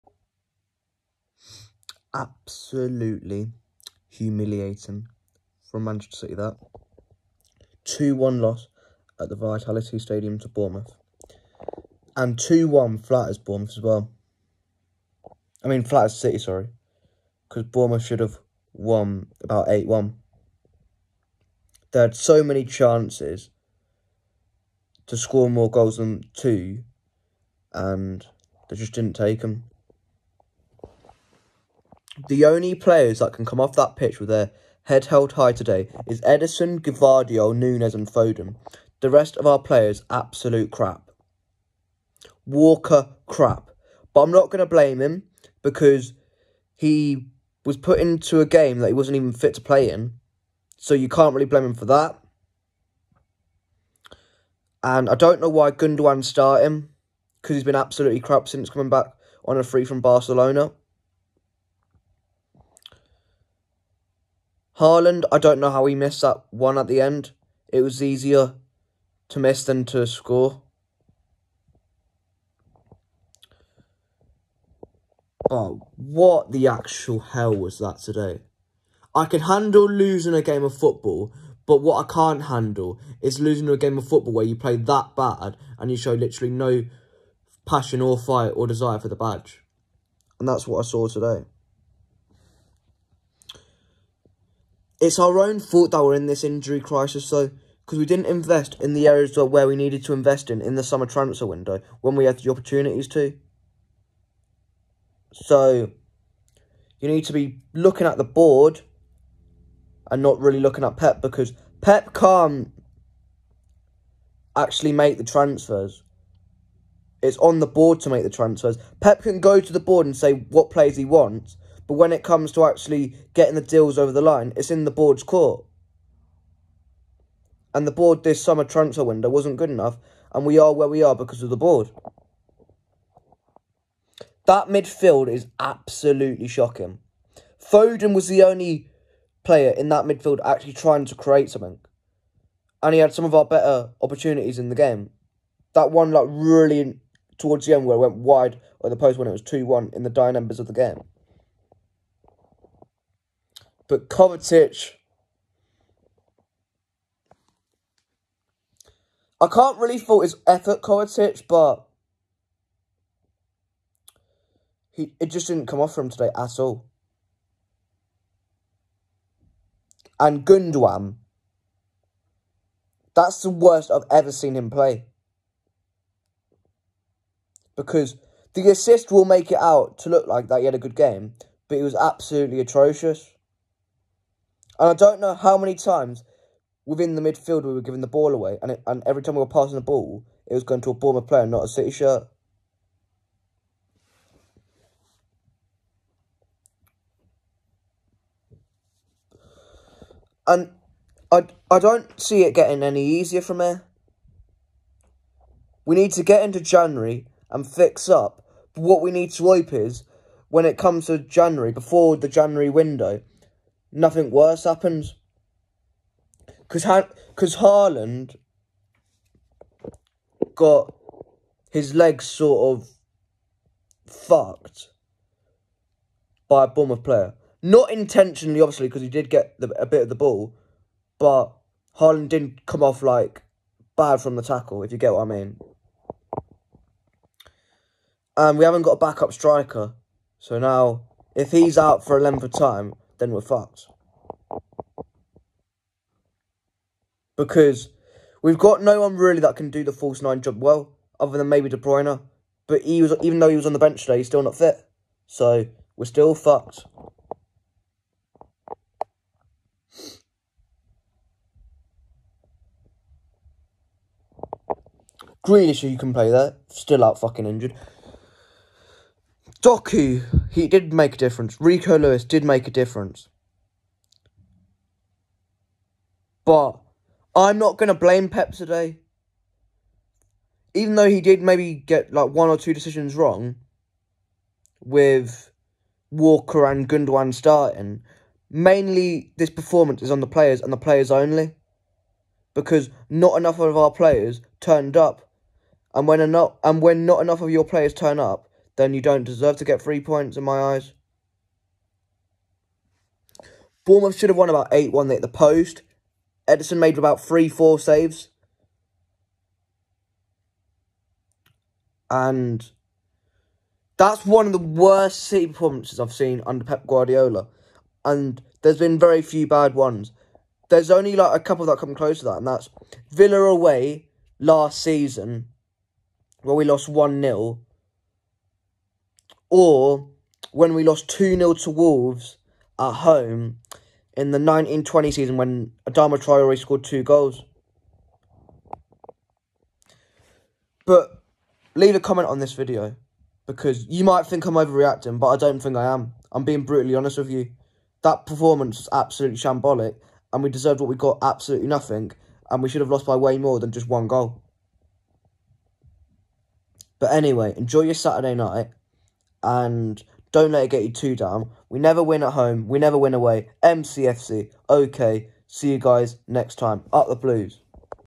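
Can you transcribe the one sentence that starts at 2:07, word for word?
And the board this summer transfer window wasn't good enough.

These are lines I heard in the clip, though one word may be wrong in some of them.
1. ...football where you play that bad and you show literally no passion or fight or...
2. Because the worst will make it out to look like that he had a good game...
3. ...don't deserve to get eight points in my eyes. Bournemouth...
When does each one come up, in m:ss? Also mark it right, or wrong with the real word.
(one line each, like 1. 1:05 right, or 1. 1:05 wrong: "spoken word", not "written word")
1. 1:24 right
2. 2:57 wrong: "assist", not "worst"
3. 4:59 wrong: "three", not "eight".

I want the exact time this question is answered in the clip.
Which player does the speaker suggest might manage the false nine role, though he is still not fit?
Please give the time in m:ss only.
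4:11.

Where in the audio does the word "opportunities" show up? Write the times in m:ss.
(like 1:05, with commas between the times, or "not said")
1:42, 2:24.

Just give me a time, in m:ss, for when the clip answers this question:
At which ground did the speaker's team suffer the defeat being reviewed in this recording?
0:09.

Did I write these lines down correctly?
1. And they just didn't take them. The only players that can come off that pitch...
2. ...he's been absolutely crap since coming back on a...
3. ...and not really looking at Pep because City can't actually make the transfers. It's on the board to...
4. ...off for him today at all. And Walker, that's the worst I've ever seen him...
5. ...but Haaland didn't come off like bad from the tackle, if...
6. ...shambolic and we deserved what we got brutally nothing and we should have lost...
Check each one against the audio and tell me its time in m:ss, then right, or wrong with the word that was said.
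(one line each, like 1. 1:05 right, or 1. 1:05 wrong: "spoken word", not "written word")
1. 0:27 right
2. 0:57 right
3. 1:50 wrong: "Pep", not "City"
4. 2:45 wrong: "Gundogan", not "Walker"
5. 3:51 right
6. 5:49 wrong: "absolutely", not "brutally".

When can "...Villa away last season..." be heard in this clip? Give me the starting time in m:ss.
5:23.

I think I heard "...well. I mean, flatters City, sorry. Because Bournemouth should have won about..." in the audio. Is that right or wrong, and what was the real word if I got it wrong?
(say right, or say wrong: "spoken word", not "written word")
right.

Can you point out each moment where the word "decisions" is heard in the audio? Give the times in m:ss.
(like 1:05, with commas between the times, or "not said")
4:42.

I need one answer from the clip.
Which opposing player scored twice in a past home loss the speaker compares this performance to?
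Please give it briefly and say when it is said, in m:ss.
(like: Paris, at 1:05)
Adama Traore, at 5:35.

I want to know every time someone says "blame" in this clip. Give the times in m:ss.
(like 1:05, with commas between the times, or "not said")
0:44, 0:51, 4:37.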